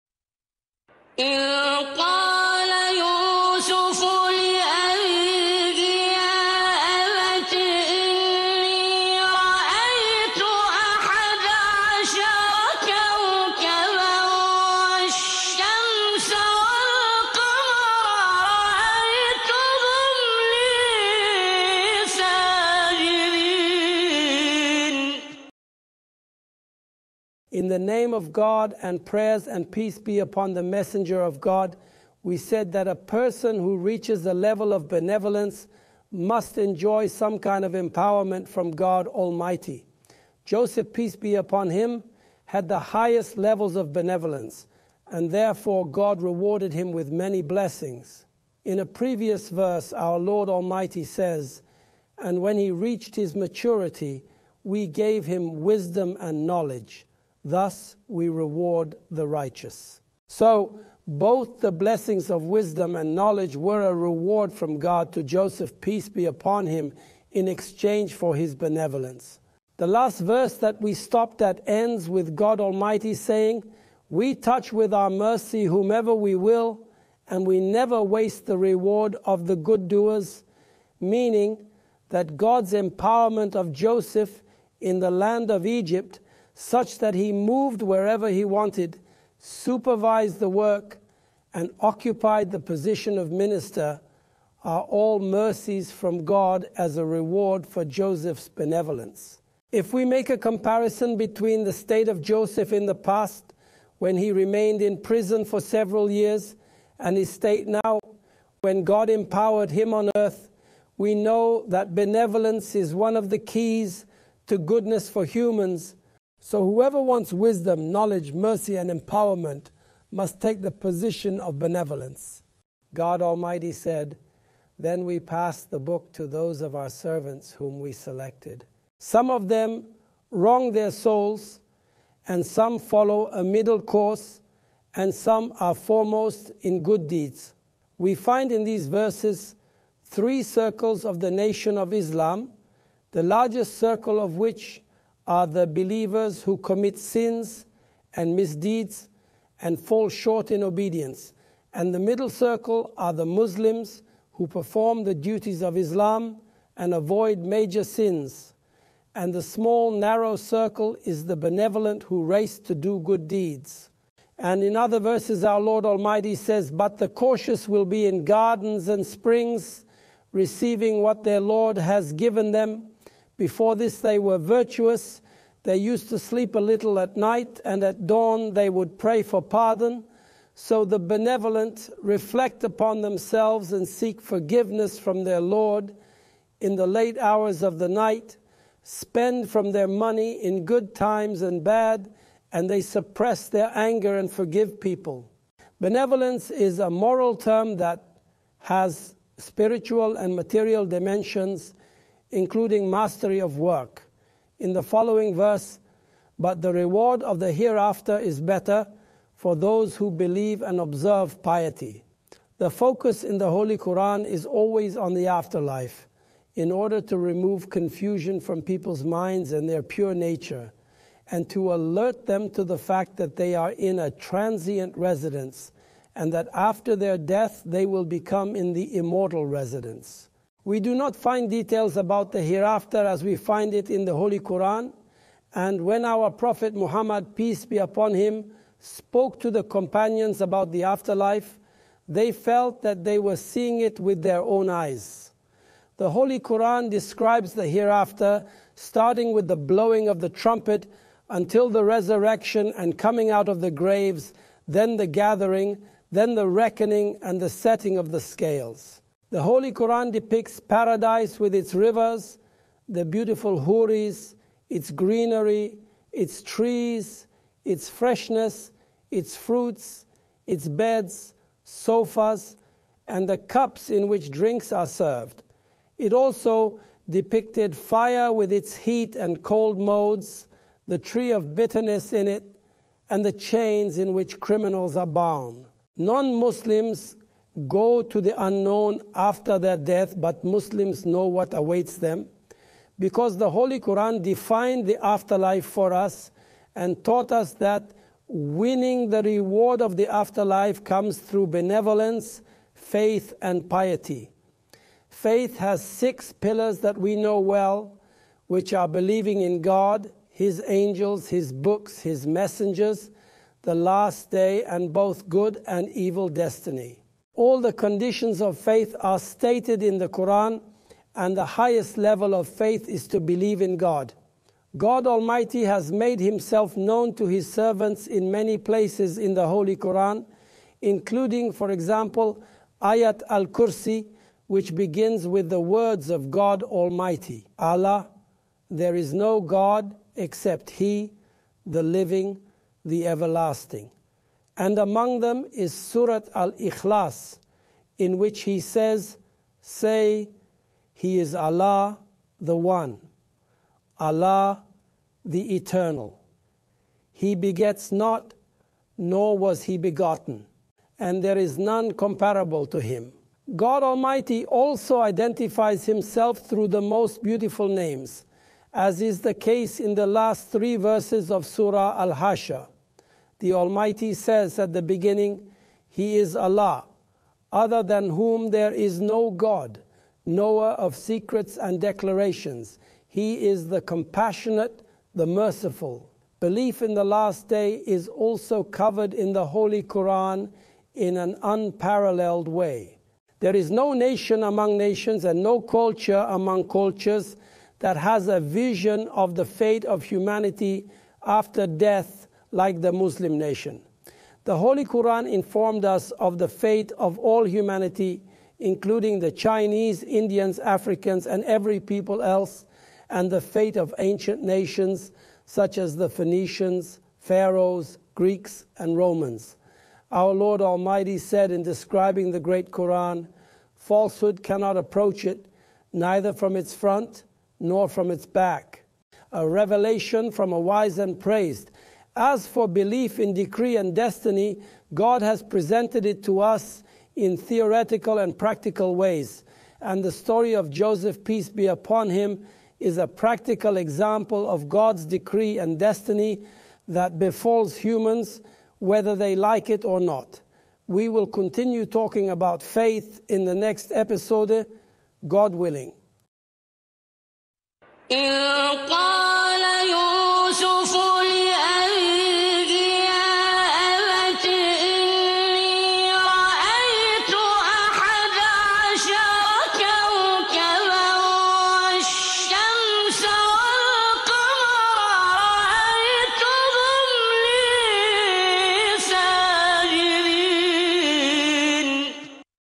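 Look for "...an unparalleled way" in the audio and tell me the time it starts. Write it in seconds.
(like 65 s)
391 s.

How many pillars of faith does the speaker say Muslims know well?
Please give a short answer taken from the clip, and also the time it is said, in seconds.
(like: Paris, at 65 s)
6, at 305 s.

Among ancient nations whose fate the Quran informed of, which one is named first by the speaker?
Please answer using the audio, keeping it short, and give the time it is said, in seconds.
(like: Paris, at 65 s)
Phoenicians, at 416 s.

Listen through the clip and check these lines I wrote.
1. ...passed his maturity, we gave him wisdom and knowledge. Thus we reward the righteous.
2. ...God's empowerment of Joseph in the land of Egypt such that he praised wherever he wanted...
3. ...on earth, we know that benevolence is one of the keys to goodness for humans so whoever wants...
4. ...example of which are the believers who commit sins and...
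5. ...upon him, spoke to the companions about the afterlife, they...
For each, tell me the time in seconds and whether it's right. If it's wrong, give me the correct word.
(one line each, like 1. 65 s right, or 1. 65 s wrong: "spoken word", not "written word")
1. 52 s wrong: "reached", not "passed"
2. 82 s wrong: "moved", not "praised"
3. 109 s right
4. 143 s wrong: "circle", not "example"
5. 237 s right.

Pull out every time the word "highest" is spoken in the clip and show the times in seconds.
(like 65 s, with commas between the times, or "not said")
42 s, 321 s.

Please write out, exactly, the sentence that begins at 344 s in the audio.
And among them is Surat al Ikhlas, in which he says, Say, He is Allah the One, Allah the Eternal.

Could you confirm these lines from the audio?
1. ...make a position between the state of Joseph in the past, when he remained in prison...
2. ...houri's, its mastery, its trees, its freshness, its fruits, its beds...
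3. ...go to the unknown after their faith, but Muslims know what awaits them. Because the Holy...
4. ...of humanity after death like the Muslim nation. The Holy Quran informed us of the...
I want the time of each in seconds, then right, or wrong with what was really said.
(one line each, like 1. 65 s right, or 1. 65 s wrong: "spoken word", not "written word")
1. 100 s wrong: "comparison", not "position"
2. 263 s wrong: "greenery", not "mastery"
3. 287 s wrong: "death", not "faith"
4. 399 s right.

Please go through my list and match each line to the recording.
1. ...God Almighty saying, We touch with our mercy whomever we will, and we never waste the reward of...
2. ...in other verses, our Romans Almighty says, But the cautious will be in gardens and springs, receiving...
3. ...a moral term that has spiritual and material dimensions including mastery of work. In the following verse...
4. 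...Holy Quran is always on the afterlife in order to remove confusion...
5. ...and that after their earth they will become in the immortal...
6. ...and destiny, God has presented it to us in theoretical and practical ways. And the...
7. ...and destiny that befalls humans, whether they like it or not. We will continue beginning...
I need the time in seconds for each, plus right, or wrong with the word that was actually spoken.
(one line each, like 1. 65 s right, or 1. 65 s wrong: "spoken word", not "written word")
1. 72 s right
2. 164 s wrong: "Lord", not "Romans"
3. 196 s right
4. 213 s right
5. 226 s wrong: "death", not "earth"
6. 433 s right
7. 445 s wrong: "talking", not "beginning".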